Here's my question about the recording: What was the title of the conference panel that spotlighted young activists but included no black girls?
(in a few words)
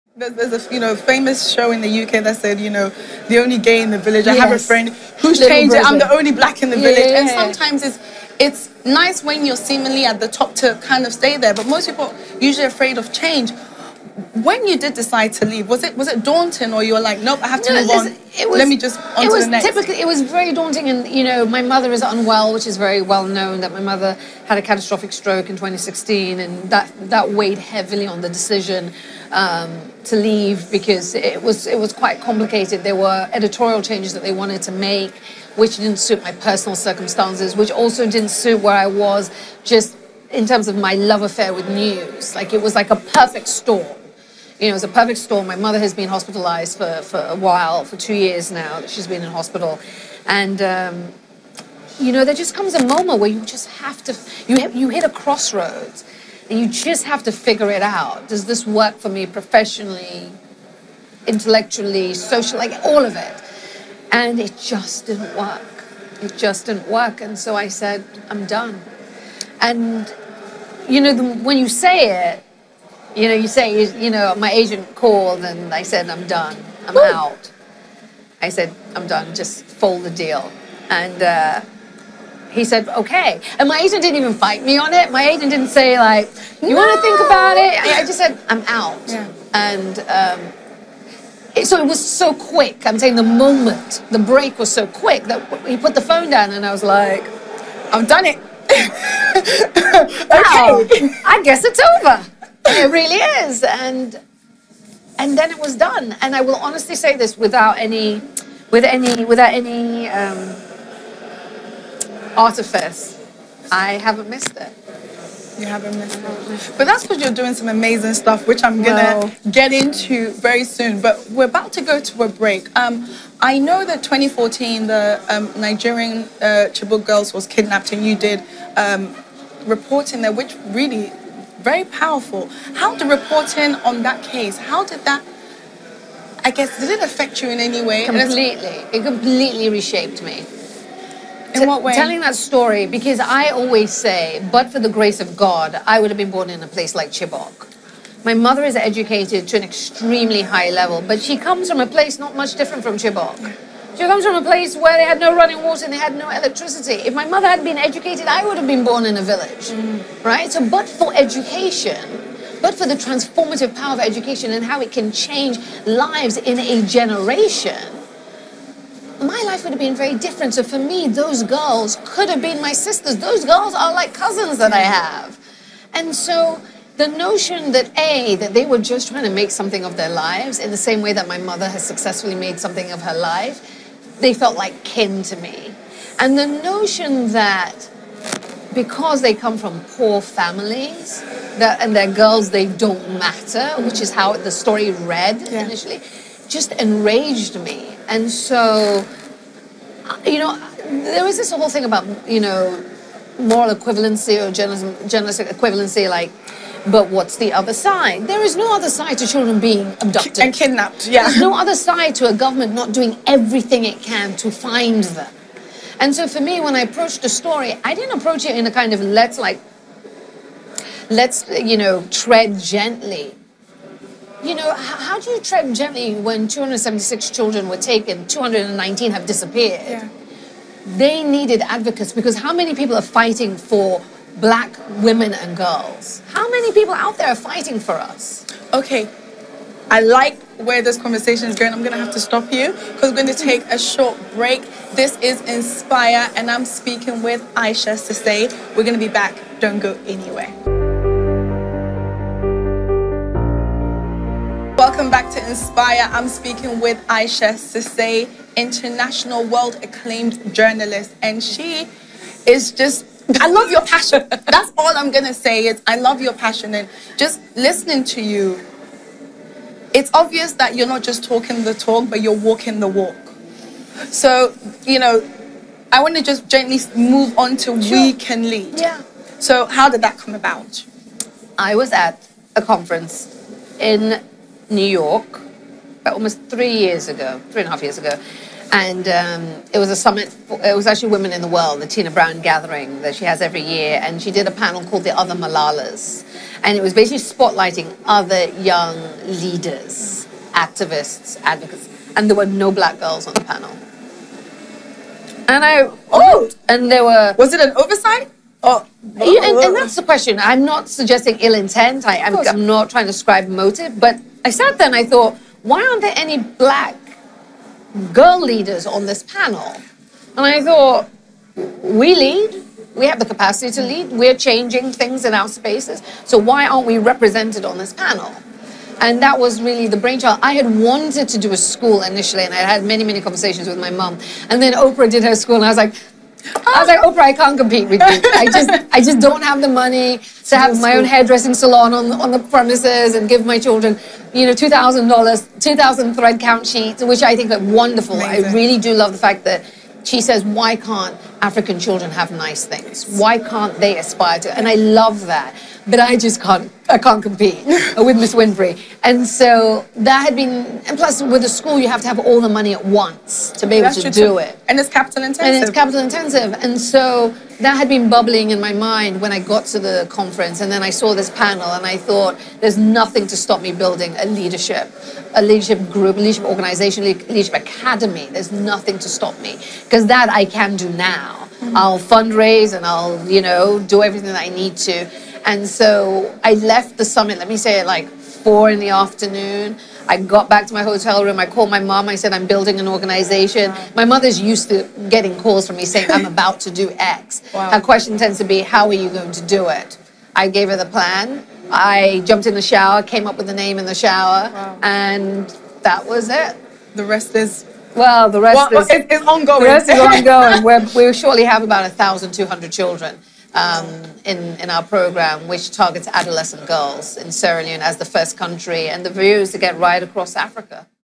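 The Other Malalas.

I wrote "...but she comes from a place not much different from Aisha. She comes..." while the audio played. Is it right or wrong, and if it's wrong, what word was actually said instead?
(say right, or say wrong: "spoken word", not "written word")
wrong: "Chibok", not "Aisha".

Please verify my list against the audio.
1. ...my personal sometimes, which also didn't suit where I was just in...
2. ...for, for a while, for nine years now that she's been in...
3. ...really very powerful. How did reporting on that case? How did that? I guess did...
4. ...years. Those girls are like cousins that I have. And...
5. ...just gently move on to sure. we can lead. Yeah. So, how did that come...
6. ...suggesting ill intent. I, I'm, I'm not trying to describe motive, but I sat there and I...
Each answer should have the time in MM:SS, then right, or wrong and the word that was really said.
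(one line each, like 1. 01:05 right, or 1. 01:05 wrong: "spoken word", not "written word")
1. 00:36 wrong: "circumstances", not "sometimes"
2. 00:46 wrong: "two", not "nine"
3. 02:10 right
4. 02:52 wrong: "sisters", not "years"
5. 04:36 right
6. 05:10 right.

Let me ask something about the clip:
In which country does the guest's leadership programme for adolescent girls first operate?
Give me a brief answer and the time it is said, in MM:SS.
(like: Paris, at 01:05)
Sierra Leone, at 06:57.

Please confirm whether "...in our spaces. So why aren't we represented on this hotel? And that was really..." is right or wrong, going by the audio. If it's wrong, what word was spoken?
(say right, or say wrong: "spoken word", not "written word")
wrong: "panel", not "hotel".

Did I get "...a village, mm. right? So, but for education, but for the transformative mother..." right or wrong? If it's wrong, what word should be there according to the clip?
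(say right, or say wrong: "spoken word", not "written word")
wrong: "power", not "mother".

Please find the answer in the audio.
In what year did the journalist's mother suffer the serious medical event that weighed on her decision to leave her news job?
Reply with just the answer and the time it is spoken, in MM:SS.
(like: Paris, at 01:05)
2016, at 00:25.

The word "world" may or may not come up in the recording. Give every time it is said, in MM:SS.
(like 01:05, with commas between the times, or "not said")
04:19, 04:51.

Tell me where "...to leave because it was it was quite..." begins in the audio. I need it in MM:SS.
00:30.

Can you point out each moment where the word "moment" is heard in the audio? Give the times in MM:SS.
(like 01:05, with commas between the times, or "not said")
00:52, 01:33.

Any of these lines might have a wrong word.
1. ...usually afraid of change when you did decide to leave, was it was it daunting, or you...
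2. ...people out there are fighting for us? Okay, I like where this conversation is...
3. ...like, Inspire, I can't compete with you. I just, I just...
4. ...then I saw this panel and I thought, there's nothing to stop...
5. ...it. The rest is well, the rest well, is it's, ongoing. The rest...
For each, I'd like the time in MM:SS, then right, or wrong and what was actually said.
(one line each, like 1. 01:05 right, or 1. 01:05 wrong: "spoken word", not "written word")
1. 00:12 right
2. 03:56 right
3. 05:36 wrong: "Oprah", not "Inspire"
4. 06:10 right
5. 06:46 right.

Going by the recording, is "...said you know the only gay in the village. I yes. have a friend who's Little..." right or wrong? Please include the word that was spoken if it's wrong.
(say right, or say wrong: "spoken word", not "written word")
right.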